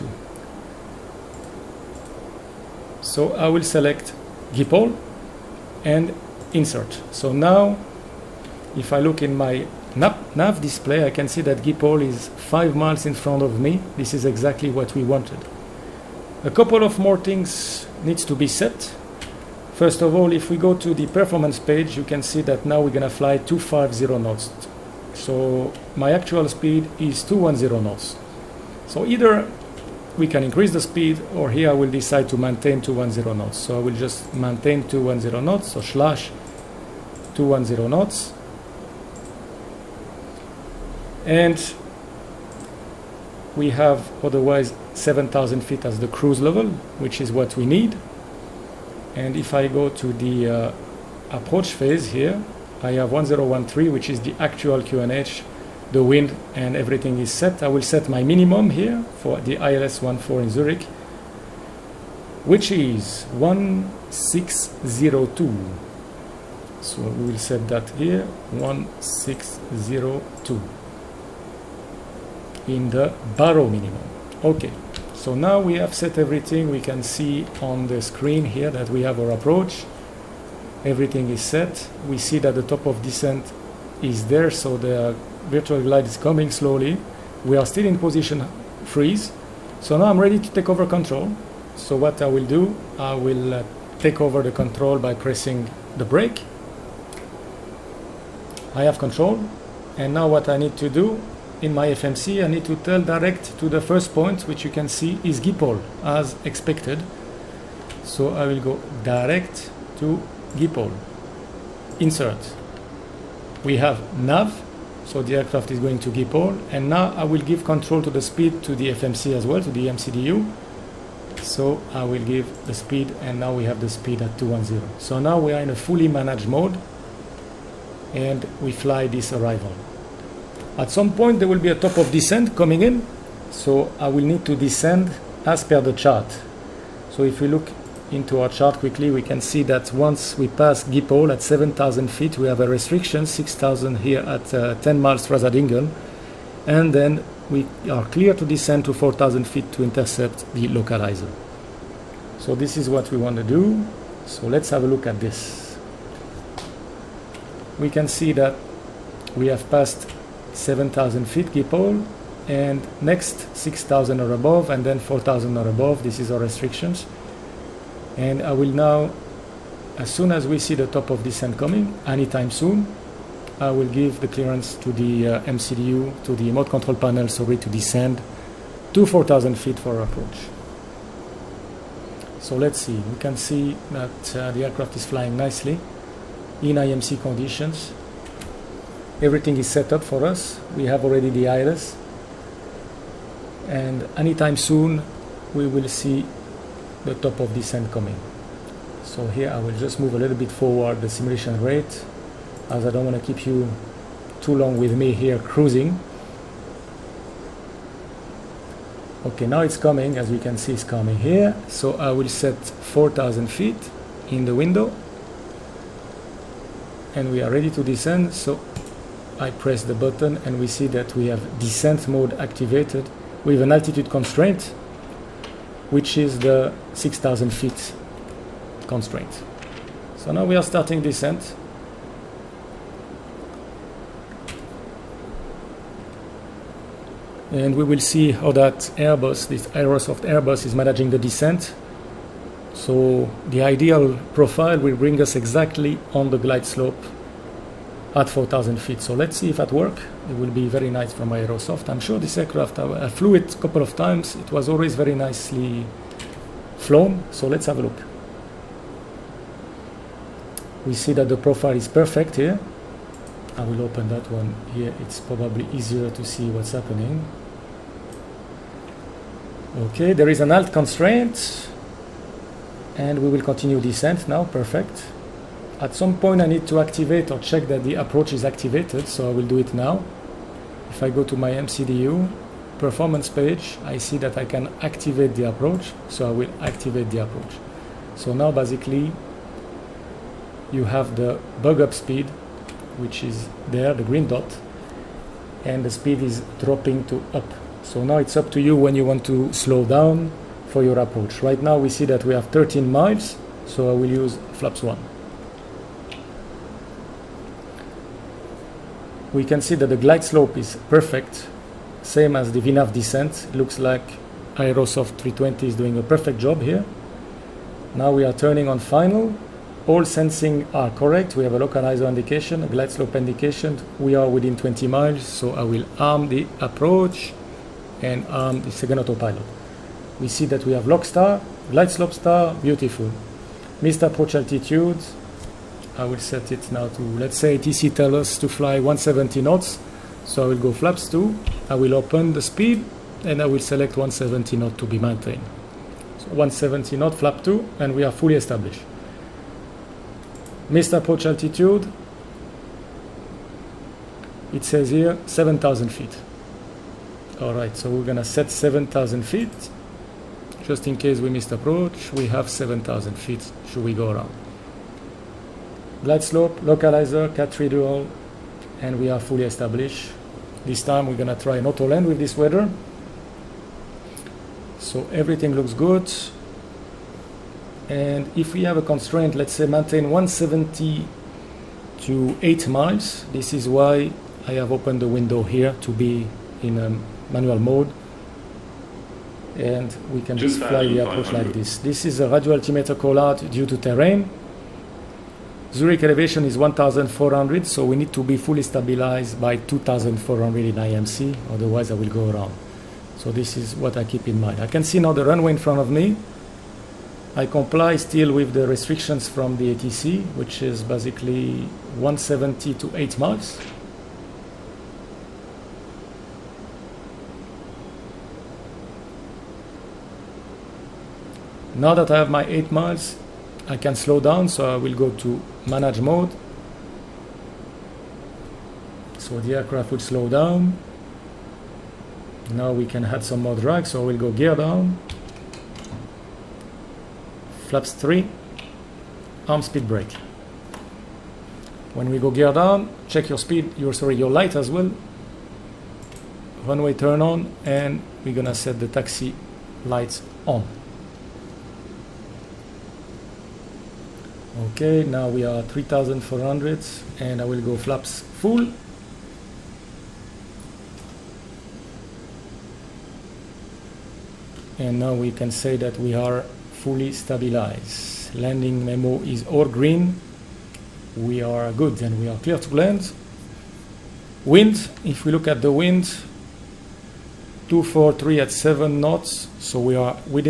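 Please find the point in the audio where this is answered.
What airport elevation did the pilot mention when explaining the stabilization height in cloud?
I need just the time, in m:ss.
6:36.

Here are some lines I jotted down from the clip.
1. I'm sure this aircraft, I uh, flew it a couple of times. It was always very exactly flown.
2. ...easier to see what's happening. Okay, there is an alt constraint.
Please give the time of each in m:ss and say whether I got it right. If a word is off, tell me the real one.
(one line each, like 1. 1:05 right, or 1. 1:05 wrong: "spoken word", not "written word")
1. 4:11 wrong: "nicely", not "exactly"
2. 4:25 right.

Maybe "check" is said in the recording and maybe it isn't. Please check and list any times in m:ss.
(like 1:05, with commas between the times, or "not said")
4:37, 7:23.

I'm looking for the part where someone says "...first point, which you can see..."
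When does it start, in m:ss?
1:43.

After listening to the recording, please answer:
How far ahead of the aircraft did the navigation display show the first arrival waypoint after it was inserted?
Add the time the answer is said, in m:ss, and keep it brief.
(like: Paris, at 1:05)
5 miles, at 0:12.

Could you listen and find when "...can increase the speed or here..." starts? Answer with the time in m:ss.
0:30.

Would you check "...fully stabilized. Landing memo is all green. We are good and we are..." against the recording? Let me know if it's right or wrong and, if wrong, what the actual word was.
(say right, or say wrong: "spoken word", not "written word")
right.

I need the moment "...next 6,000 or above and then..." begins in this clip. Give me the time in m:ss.
2:43.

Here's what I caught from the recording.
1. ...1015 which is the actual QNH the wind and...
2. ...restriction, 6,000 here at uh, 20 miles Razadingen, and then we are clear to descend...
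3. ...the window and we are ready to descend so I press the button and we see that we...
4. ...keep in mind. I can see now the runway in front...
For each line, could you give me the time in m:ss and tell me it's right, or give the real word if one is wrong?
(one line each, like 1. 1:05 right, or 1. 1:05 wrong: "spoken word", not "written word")
1. 0:53 wrong: "1013", not "1015"
2. 2:22 wrong: "10", not "20"
3. 3:34 right
4. 6:44 right.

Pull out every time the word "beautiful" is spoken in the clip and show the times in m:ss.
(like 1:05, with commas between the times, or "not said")
5:32.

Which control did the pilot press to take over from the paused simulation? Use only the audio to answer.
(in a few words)
The brake.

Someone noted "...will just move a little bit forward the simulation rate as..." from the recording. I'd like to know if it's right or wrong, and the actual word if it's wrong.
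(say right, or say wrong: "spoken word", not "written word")
right.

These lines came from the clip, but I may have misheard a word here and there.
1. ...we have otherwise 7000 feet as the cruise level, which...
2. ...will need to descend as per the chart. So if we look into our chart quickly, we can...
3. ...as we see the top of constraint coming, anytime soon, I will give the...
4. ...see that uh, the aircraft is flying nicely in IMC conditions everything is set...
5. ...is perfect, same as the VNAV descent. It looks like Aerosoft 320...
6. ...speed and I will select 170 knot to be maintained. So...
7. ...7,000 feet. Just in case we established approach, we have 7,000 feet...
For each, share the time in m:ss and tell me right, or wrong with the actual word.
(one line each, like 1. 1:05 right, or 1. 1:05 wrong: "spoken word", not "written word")
1. 0:43 right
2. 2:14 right
3. 2:50 wrong: "descent", not "constraint"
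4. 3:03 right
5. 5:10 right
6. 5:42 right
7. 5:58 wrong: "missed", not "established".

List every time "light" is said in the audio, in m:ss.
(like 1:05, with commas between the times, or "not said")
7:24, 7:29.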